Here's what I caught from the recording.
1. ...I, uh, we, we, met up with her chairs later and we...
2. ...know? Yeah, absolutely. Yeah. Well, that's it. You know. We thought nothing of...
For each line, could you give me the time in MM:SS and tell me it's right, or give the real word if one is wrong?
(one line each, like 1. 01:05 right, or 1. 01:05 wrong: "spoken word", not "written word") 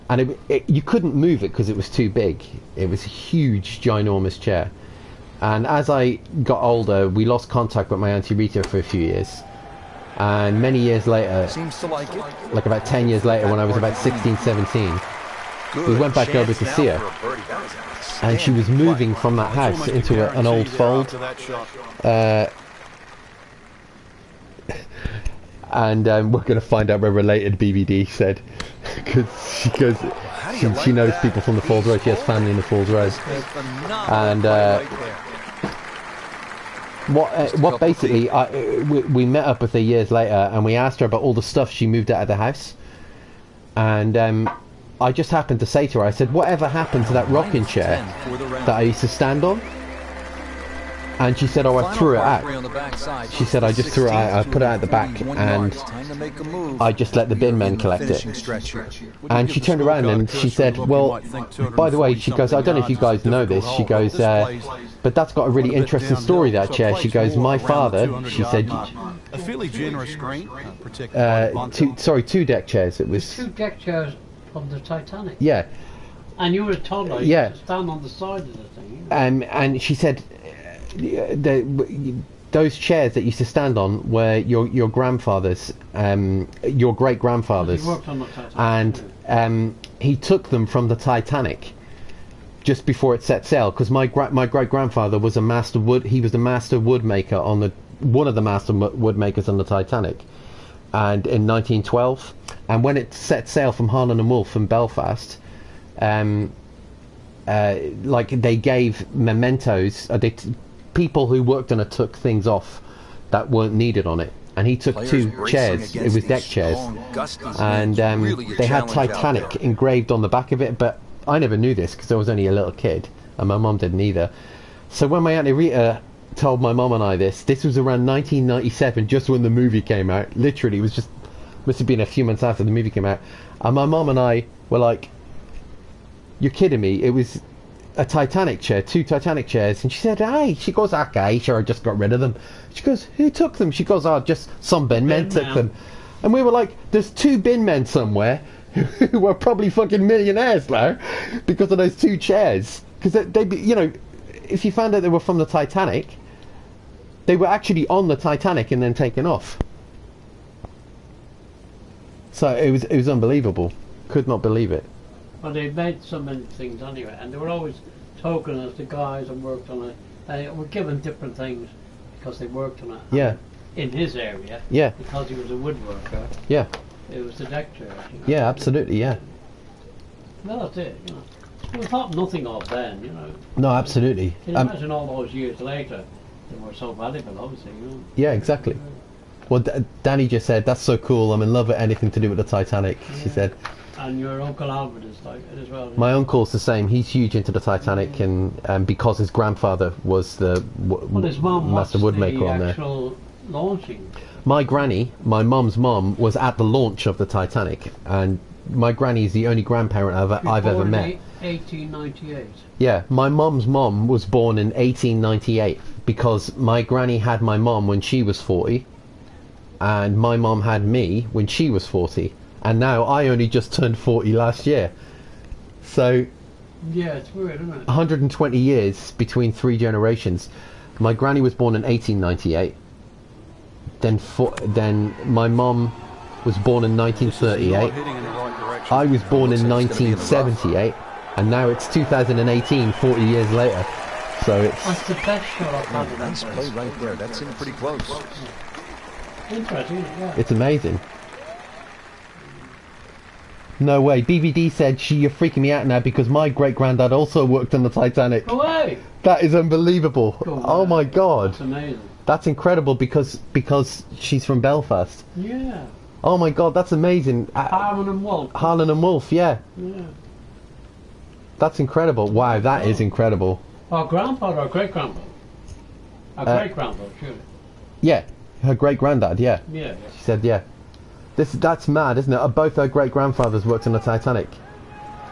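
1. 00:38 wrong: "years", not "chairs"
2. 02:58 right.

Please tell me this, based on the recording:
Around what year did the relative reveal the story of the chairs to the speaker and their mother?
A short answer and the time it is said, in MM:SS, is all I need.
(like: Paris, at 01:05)
1997, at 02:08.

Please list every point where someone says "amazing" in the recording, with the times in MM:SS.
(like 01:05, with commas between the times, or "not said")
04:10, 04:21, 04:26.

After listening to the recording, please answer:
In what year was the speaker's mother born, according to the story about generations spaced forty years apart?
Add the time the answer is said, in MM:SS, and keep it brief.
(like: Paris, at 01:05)
1938, at 03:56.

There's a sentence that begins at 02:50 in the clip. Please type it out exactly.
They were given different things because they worked on it.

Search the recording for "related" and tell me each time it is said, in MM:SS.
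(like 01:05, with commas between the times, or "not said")
00:27.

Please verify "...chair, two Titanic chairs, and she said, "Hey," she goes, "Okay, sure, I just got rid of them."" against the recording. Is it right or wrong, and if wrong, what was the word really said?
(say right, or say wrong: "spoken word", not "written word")
right.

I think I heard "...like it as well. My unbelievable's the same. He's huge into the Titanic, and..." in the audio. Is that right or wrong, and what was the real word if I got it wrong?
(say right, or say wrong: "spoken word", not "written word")
wrong: "uncle", not "unbelievable".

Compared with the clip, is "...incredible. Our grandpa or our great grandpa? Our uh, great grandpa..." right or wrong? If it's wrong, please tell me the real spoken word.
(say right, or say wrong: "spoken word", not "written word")
right.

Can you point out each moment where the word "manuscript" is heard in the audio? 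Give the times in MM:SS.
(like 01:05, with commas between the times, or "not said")
not said.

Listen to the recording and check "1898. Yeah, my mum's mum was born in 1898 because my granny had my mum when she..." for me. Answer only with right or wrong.
right.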